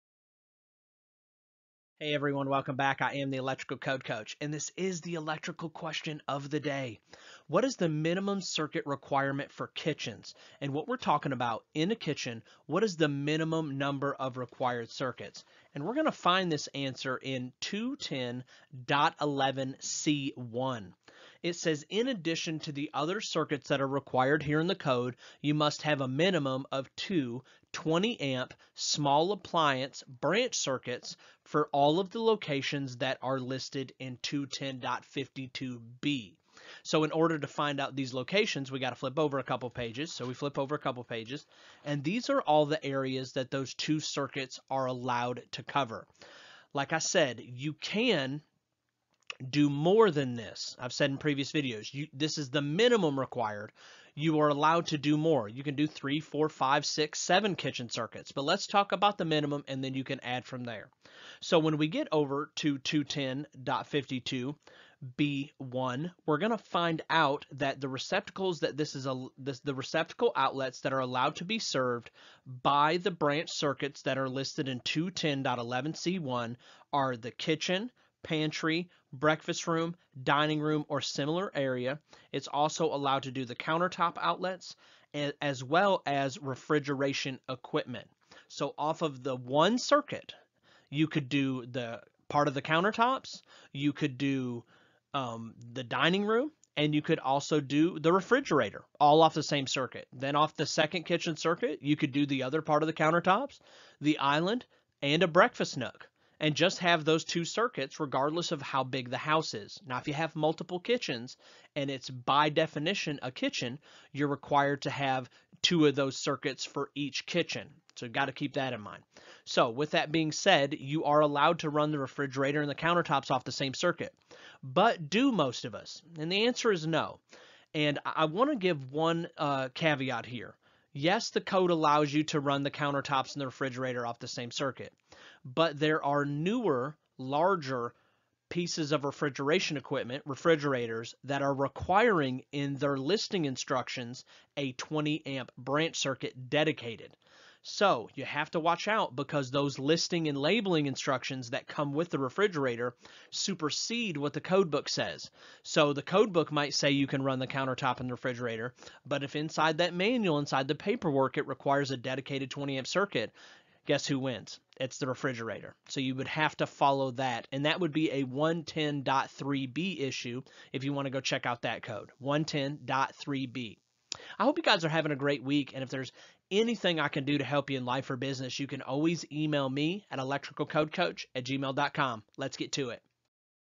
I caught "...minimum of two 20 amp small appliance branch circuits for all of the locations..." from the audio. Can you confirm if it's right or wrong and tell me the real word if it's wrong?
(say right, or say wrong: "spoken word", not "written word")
right.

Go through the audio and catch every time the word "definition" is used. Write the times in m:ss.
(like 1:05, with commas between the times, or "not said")
1:52.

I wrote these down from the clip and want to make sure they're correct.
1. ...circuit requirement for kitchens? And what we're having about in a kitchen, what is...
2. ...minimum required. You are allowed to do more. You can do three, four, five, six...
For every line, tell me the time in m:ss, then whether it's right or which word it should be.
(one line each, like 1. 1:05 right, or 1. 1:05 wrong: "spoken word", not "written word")
1. 0:08 wrong: "talking", not "having"
2. 0:52 right.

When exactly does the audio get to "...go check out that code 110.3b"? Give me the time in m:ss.
2:51.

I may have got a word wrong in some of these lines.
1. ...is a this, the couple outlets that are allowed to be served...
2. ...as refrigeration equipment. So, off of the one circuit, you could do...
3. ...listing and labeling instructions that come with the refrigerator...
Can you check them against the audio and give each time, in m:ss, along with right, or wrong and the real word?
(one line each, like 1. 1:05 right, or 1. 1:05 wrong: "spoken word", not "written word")
1. 1:08 wrong: "receptacle", not "couple"
2. 1:26 right
3. 2:29 right.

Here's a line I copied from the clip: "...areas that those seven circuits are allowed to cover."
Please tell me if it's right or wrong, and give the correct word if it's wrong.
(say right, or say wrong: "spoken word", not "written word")
wrong: "two", not "seven".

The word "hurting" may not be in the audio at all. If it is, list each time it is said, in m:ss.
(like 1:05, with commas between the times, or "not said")
not said.